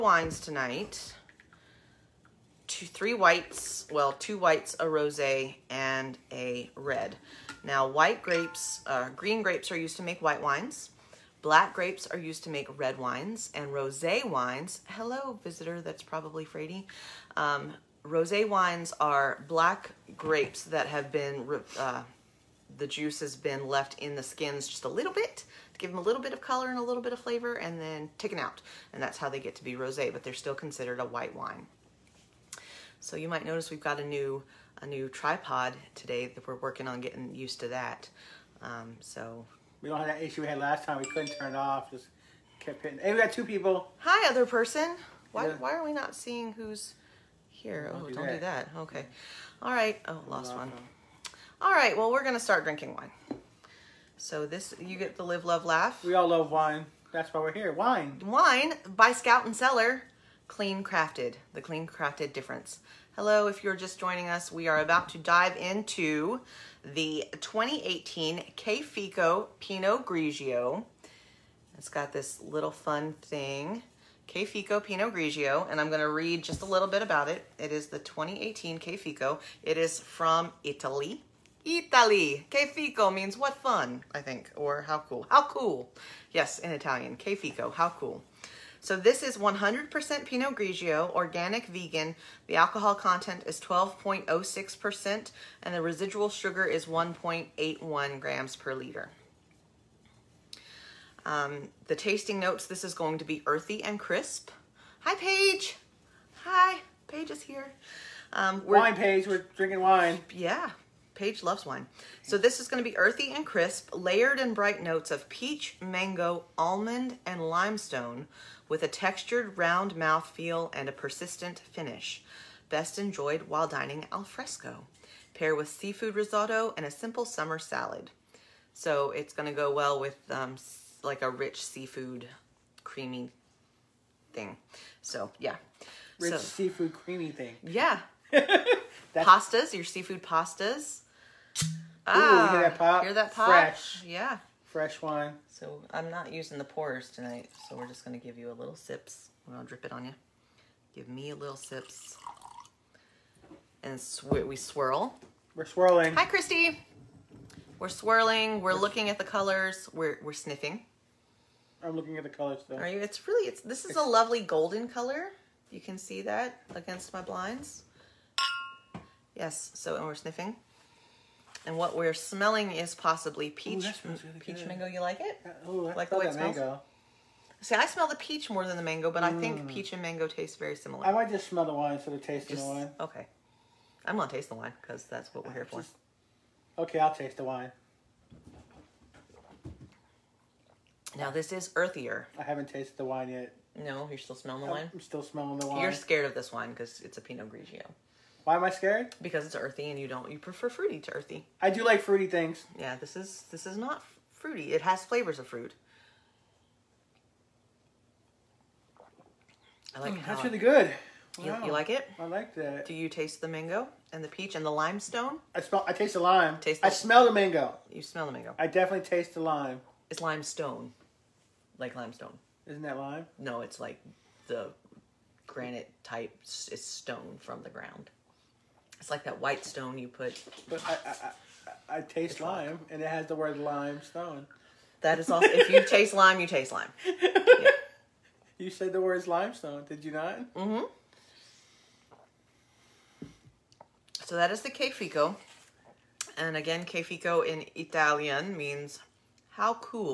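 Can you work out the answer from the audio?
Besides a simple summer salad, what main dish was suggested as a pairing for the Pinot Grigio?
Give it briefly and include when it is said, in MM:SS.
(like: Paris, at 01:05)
Seafood risotto, at 02:05.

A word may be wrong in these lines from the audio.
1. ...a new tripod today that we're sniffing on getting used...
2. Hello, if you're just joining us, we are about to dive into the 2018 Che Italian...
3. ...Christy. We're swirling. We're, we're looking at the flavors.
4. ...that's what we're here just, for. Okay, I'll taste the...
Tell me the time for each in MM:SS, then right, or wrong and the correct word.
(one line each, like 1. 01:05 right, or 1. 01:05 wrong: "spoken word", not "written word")
1. 00:34 wrong: "working", not "sniffing"
2. 01:03 wrong: "Fico", not "Italian"
3. 02:36 wrong: "colors", not "flavors"
4. 03:05 right.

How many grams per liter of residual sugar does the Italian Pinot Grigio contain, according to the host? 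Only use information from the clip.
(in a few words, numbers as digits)
1.81.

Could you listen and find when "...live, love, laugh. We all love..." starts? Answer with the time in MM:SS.
00:55.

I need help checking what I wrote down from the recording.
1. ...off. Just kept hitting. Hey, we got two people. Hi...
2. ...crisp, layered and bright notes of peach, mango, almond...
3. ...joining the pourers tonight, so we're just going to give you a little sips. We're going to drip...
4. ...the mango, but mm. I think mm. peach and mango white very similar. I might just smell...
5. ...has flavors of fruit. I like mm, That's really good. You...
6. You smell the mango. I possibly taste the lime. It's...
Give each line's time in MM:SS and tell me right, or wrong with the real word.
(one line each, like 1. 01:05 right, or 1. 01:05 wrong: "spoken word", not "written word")
1. 00:41 right
2. 01:53 right
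3. 02:26 wrong: "using", not "joining"
4. 02:58 wrong: "taste", not "white"
5. 03:24 right
6. 03:37 wrong: "definitely", not "possibly".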